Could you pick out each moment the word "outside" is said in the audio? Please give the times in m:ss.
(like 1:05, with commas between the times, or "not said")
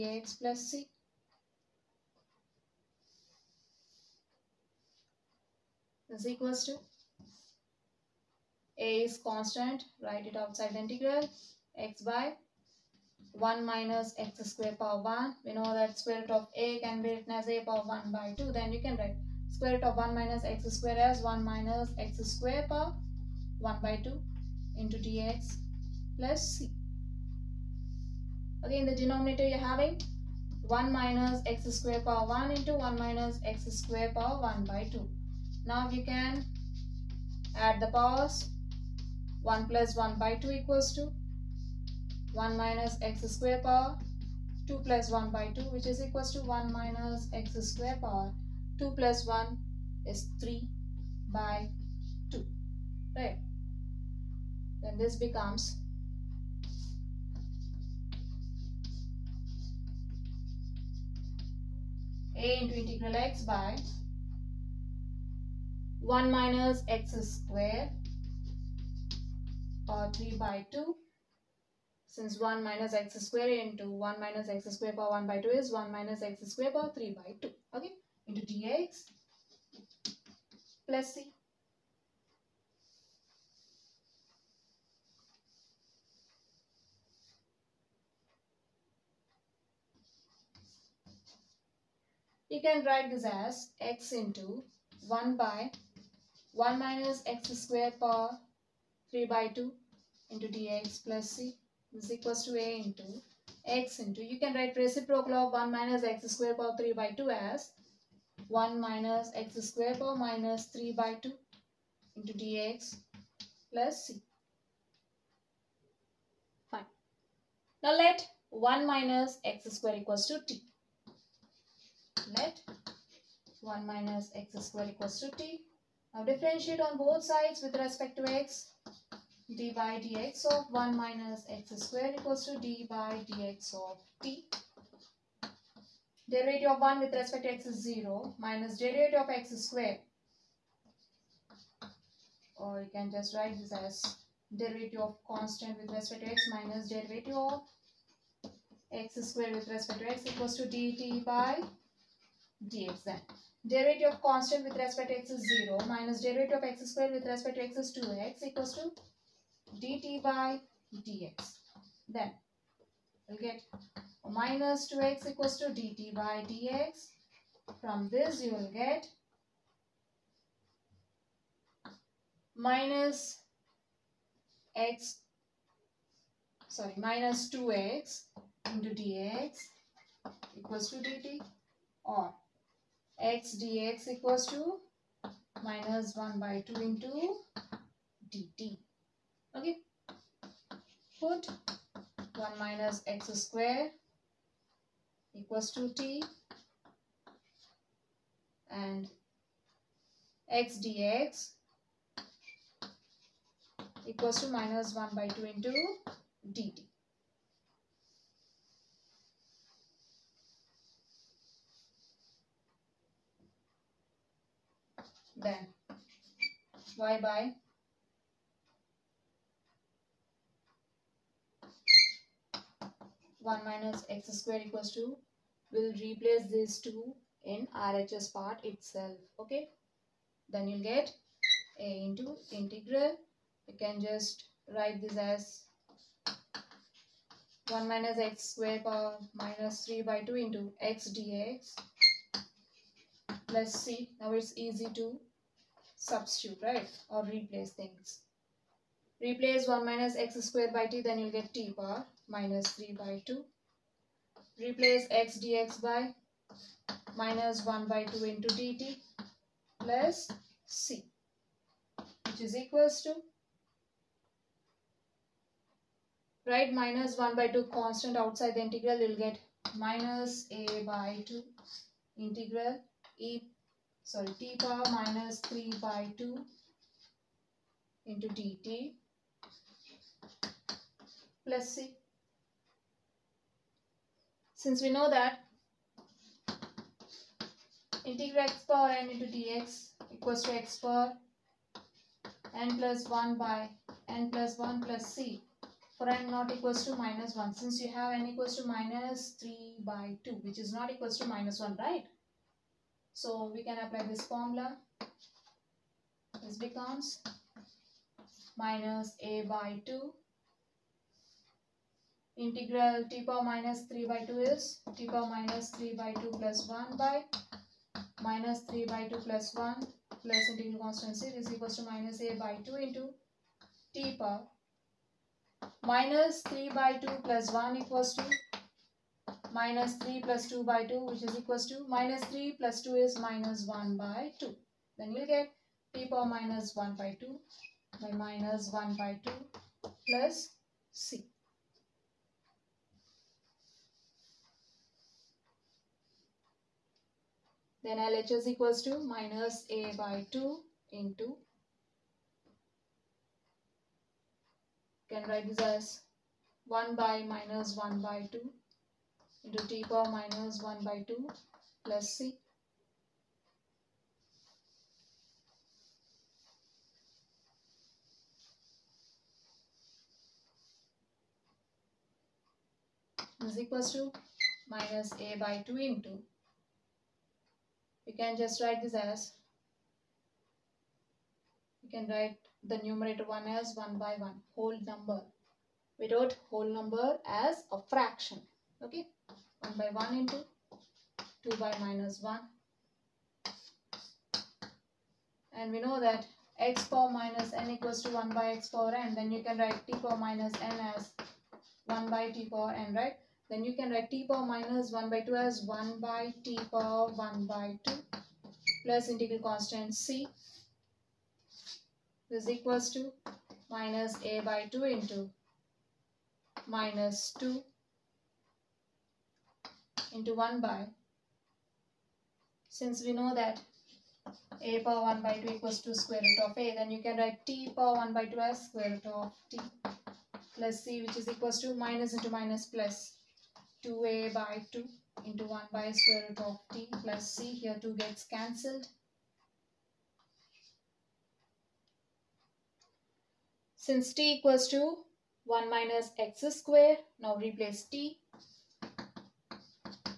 0:10, 4:28.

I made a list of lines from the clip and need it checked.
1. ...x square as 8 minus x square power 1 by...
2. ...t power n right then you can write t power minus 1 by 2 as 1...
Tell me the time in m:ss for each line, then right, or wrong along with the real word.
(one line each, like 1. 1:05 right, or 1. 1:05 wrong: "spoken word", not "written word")
1. 0:20 wrong: "1", not "8"
2. 6:42 right.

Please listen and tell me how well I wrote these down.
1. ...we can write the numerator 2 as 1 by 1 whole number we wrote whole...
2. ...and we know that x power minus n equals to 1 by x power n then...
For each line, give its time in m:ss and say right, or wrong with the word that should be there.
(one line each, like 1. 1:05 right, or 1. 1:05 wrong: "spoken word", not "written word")
1. 6:21 wrong: "1", not "2"
2. 6:35 right.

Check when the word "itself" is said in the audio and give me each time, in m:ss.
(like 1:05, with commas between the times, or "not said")
3:48.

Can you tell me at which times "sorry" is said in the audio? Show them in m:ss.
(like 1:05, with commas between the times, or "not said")
2:56, 4:34.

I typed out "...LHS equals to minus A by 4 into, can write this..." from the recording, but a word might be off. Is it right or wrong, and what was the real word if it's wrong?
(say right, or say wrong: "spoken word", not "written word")
wrong: "2", not "4".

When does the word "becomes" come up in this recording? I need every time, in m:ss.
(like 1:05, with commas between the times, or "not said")
0:55, 5:06.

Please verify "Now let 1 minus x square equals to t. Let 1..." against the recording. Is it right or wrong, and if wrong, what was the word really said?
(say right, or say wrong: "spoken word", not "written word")
right.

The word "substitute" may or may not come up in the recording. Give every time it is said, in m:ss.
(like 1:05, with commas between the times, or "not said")
4:05.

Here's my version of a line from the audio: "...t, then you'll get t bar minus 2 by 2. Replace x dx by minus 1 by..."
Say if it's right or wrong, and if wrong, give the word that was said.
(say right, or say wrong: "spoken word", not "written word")
wrong: "3", not "2".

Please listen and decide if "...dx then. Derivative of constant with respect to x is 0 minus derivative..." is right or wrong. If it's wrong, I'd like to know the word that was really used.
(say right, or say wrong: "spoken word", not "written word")
right.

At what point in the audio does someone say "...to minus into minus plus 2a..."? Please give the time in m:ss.
7:11.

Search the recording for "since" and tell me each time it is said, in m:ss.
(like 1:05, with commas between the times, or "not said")
1:12, 4:44, 4:57, 7:02, 7:23.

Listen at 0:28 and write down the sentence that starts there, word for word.
Again, the denominator you're having 1 minus x square power 1 into 1 minus x square power 1 by 2.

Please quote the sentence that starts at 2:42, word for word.
Then we'll get minus 2x equals to dt by dx.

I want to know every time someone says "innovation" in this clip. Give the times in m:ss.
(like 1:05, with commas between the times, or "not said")
not said.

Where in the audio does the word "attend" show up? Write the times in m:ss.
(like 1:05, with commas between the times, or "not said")
not said.